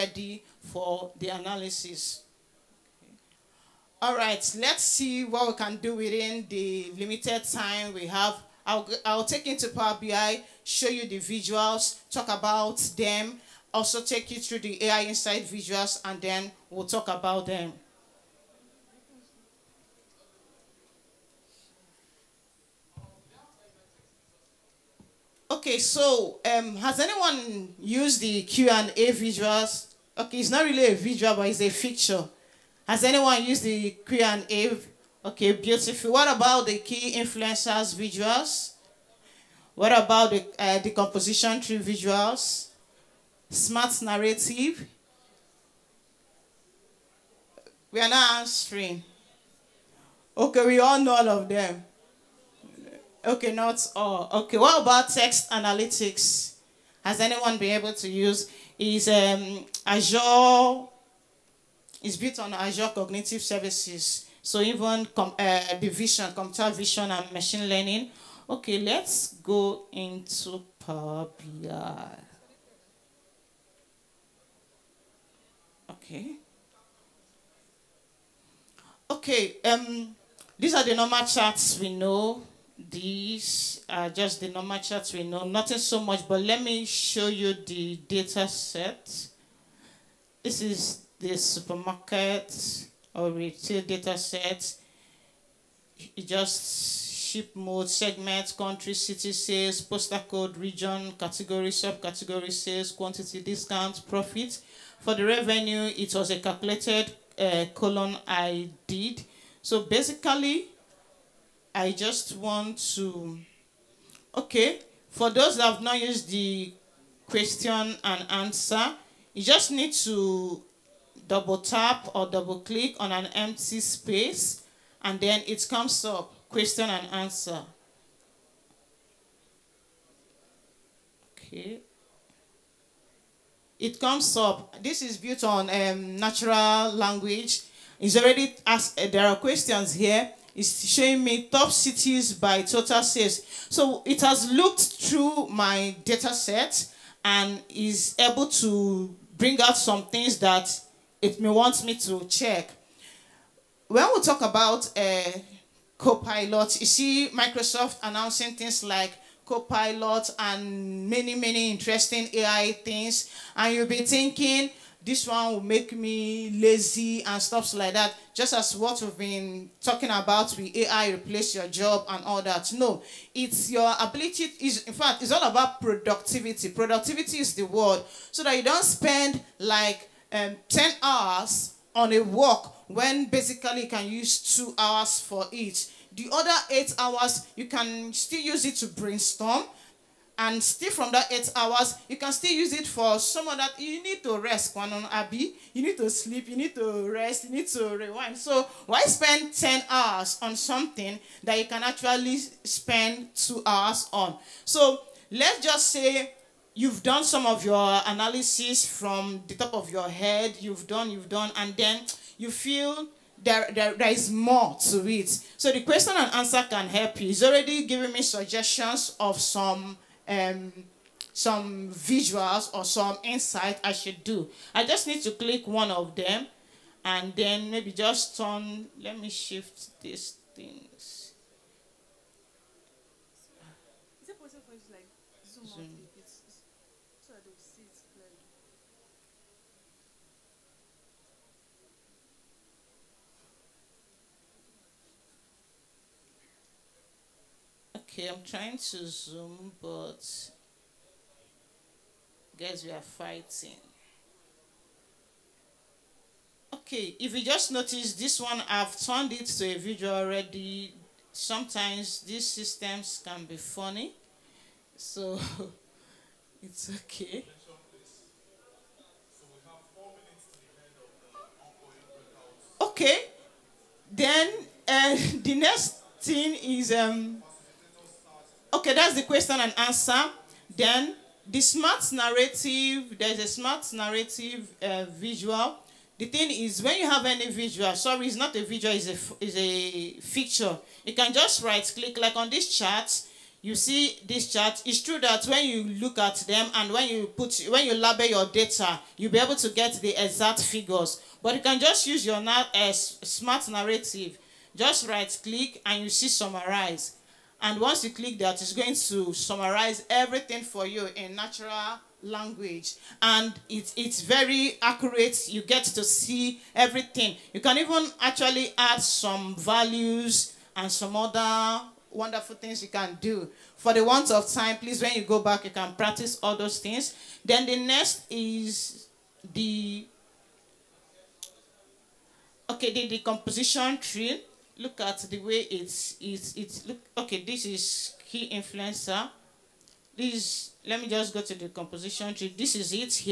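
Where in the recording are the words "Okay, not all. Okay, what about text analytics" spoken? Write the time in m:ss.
0:53.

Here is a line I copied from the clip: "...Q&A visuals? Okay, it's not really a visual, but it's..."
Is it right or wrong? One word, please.
right.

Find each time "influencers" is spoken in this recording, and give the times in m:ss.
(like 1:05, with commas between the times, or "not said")
0:37, 5:38.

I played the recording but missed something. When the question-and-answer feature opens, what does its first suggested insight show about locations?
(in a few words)
Top cities by total sales.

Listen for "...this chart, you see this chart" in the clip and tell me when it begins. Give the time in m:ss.
4:52.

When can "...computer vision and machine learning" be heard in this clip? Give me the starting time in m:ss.
1:06.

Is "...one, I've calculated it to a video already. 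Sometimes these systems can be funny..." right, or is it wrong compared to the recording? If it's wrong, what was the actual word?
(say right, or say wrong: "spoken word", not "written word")
wrong: "turned", not "calculated".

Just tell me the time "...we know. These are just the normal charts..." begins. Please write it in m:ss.
1:21.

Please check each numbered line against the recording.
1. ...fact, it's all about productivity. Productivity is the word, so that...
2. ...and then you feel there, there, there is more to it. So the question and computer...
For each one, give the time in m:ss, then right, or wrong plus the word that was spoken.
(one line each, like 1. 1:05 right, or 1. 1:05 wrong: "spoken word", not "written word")
1. 2:54 right
2. 3:31 wrong: "answer", not "computer".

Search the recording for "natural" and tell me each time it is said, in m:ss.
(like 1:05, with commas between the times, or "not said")
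2:16, 5:11.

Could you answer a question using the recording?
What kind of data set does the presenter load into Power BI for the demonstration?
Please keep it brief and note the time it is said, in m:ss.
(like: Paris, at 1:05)
Supermarket or retail, at 1:31.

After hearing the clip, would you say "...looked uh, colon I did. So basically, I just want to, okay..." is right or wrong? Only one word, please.
wrong.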